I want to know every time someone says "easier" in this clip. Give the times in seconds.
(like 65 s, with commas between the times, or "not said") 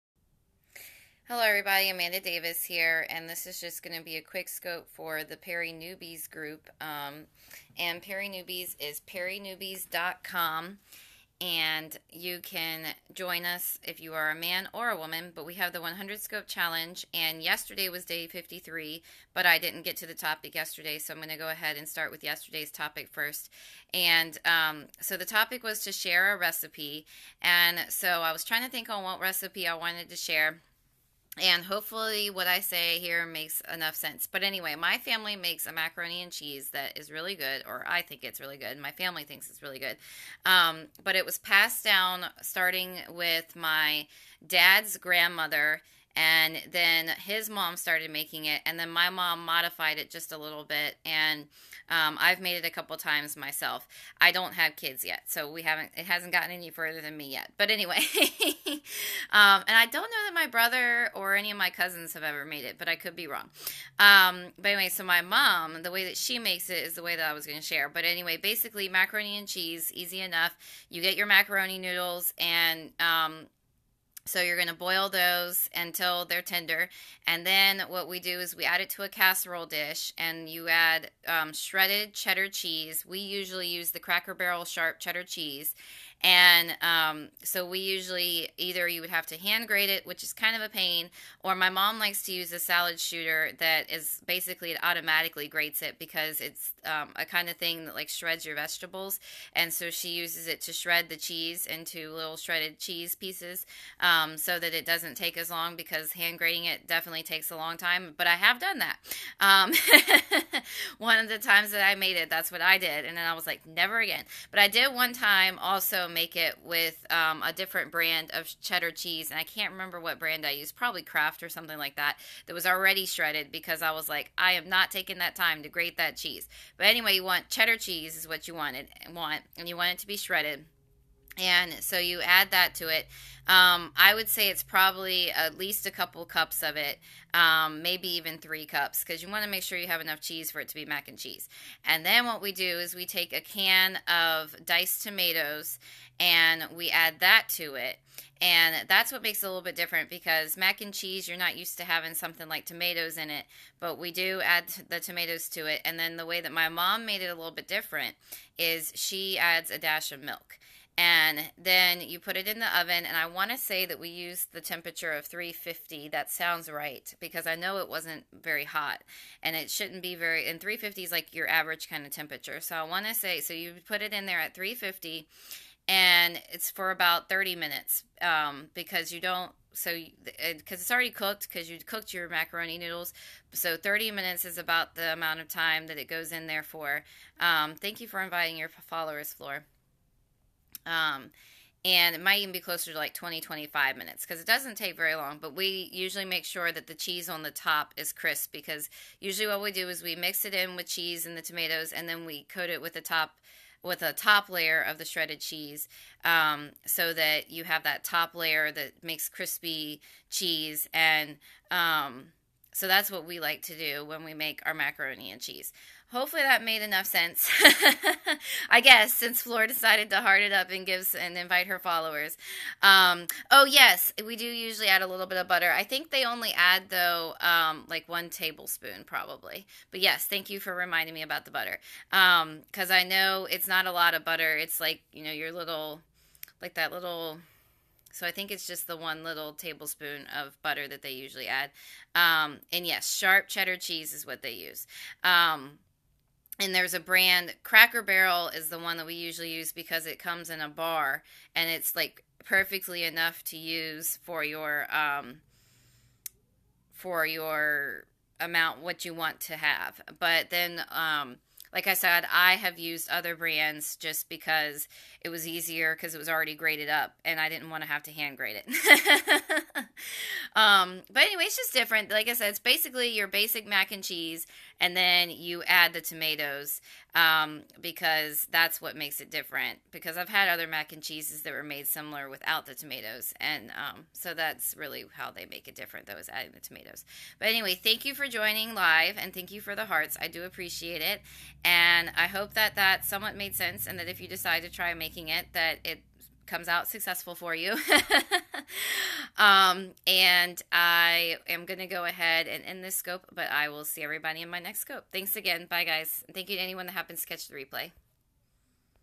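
265 s.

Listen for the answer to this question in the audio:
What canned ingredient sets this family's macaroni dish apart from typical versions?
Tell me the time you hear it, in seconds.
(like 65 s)
144 s.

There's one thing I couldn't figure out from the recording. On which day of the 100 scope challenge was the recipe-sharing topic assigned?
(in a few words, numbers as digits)
53.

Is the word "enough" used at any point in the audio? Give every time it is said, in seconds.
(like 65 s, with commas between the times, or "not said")
33 s, 70 s, 140 s, 216 s, 253 s.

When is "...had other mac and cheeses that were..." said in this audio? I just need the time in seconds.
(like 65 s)
280 s.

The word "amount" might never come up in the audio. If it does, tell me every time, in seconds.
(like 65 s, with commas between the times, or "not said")
185 s, 258 s.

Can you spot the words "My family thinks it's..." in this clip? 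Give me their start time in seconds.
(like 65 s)
38 s.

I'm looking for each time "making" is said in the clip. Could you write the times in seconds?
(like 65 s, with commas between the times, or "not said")
48 s, 294 s.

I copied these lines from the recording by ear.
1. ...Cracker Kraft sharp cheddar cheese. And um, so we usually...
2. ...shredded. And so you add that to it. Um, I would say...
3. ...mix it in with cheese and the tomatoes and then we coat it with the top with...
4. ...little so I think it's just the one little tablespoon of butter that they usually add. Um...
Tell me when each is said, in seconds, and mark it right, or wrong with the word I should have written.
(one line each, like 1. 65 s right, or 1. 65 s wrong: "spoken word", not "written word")
1. 83 s wrong: "Barrel", not "Kraft"
2. 130 s right
3. 200 s right
4. 236 s right.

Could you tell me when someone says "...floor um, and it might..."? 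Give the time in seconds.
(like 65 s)
189 s.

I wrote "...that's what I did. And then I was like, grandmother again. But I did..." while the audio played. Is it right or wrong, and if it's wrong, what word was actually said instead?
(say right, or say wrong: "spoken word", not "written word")
wrong: "never", not "grandmother".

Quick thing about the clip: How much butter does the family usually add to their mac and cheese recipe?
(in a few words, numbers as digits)
one tablespoon.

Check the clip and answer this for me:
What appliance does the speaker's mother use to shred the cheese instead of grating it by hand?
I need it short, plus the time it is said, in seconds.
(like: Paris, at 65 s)
salad shooter, at 92 s.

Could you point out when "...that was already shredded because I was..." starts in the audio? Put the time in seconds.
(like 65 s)
122 s.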